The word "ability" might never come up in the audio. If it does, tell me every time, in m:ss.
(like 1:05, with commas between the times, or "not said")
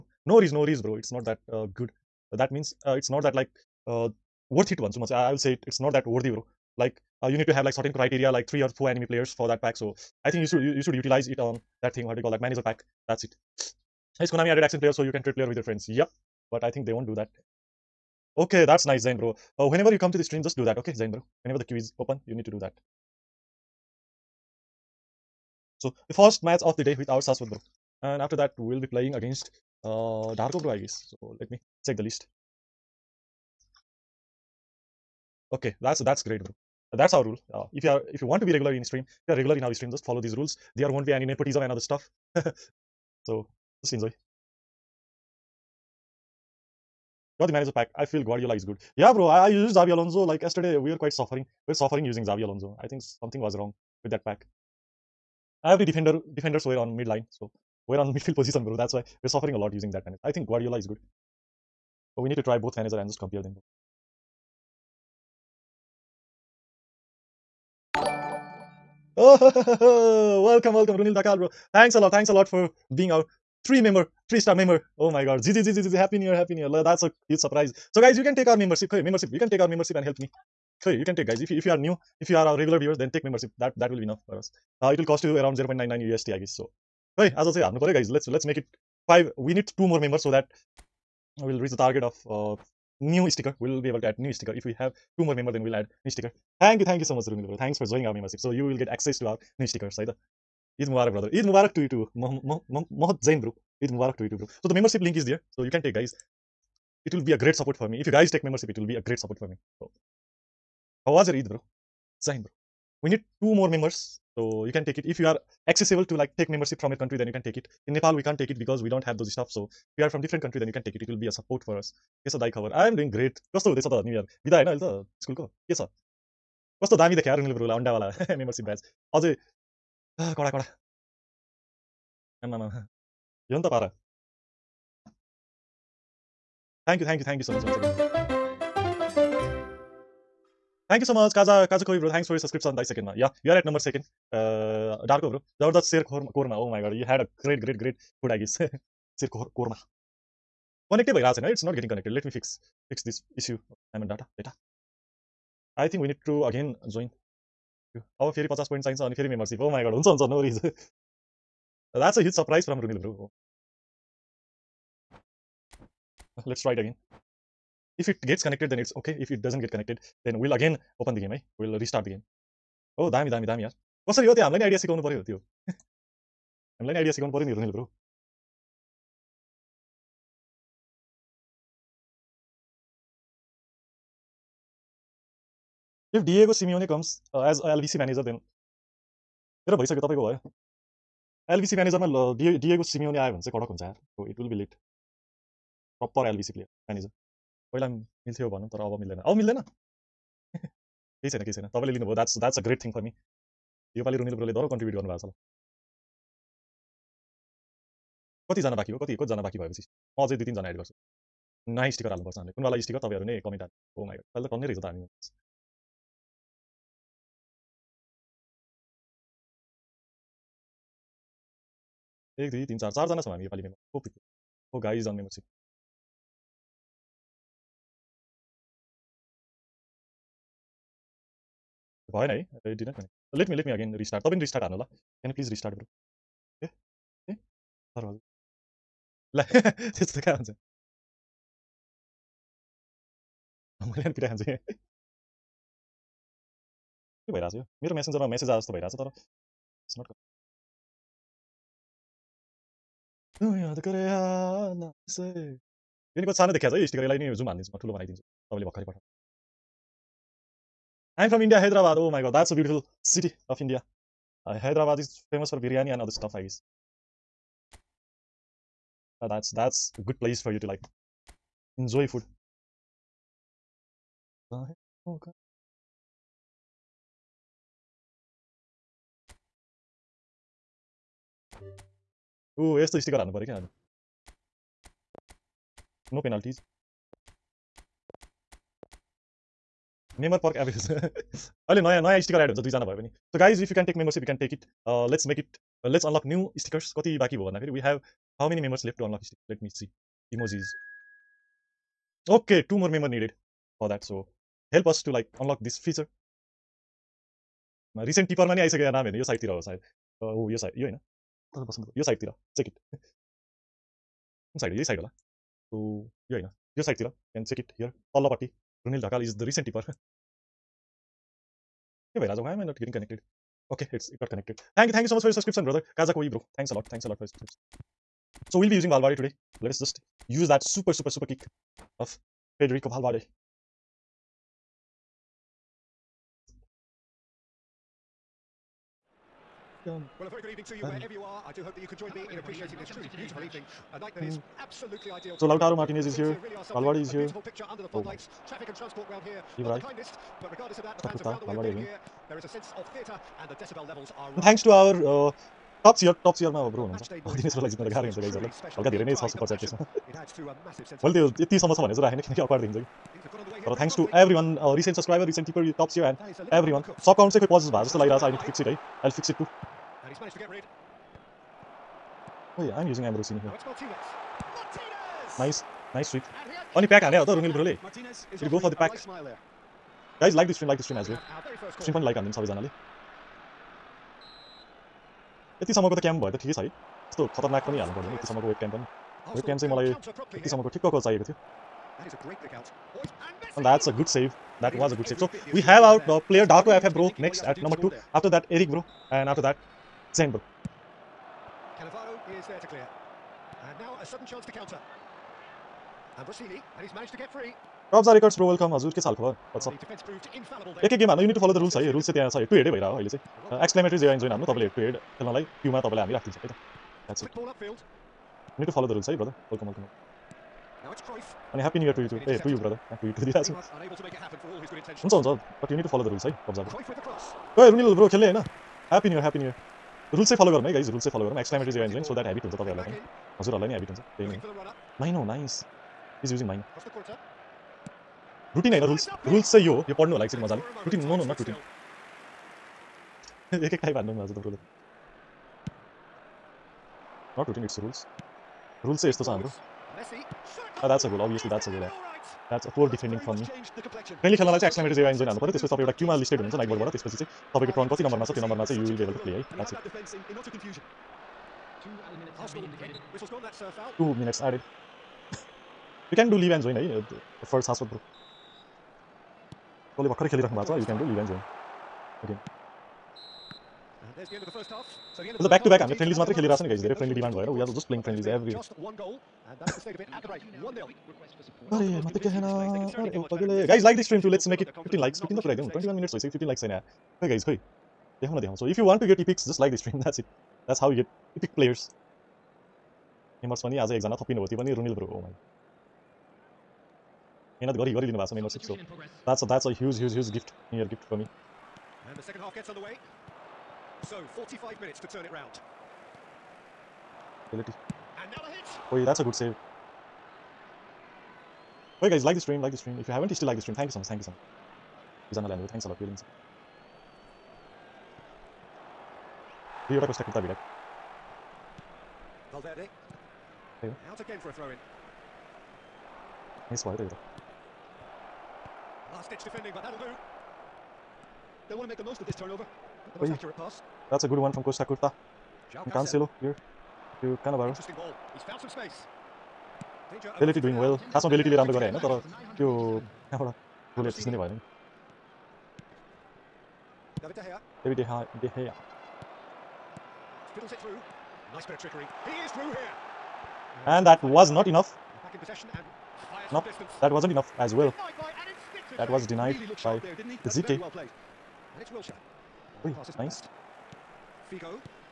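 8:27, 9:00.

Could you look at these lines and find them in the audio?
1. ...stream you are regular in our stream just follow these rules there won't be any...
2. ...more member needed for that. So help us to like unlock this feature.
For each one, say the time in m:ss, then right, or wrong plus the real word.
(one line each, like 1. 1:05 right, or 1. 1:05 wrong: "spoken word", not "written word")
1. 0:38 right
2. 5:02 right.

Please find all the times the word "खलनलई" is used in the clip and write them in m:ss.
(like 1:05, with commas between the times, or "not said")
6:55, 7:34.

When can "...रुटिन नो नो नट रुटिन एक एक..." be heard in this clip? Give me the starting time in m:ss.
7:20.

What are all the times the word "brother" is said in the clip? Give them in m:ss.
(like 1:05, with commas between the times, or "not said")
1:41, 5:25, 7:02.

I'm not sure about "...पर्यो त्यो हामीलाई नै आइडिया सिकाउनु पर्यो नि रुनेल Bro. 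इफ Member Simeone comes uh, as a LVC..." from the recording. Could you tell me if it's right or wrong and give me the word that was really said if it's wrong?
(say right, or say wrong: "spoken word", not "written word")
wrong: "Diego", not "Member".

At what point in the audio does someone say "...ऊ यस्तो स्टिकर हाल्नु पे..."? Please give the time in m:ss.
4:42.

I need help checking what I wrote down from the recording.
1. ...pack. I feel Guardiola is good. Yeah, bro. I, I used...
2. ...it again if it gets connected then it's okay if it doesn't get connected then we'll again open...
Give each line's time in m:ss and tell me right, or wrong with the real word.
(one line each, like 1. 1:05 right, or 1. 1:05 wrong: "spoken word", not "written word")
1. 0:47 right
2. 2:46 right.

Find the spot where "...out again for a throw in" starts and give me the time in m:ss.
8:44.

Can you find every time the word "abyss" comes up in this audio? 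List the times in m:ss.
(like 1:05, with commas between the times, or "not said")
4:50.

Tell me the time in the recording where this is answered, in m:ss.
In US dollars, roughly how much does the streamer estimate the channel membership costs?
1:25.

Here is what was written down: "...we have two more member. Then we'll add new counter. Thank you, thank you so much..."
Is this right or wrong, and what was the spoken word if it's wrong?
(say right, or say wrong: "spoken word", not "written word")
wrong: "sticker", not "counter".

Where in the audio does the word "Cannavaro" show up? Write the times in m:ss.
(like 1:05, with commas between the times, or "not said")
6:41, 8:57.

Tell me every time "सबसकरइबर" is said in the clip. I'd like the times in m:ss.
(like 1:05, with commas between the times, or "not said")
6:04.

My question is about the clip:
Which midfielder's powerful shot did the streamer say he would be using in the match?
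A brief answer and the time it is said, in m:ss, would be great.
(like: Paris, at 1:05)
Federico Valverde, at 5:32.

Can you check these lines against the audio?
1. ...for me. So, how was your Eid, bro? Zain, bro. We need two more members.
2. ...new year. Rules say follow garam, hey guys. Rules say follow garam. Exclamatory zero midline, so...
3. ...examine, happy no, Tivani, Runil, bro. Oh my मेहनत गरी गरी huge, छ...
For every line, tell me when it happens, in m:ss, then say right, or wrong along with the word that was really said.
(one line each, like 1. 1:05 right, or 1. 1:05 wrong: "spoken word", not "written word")
1. 1:49 right
2. 7:09 wrong: "engine", not "midline"
3. 8:13 right.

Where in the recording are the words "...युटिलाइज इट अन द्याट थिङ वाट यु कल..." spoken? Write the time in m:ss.
0:10.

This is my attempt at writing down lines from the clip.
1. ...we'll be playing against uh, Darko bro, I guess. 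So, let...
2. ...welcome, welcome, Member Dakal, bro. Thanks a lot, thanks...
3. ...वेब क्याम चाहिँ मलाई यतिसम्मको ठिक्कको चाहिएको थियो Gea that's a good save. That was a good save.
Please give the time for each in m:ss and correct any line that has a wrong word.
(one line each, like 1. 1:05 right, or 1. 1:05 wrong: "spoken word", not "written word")
1. 0:28 right
2. 1:10 wrong: "Runil", not "Member"
3. 6:29 wrong: "And", not "Gea".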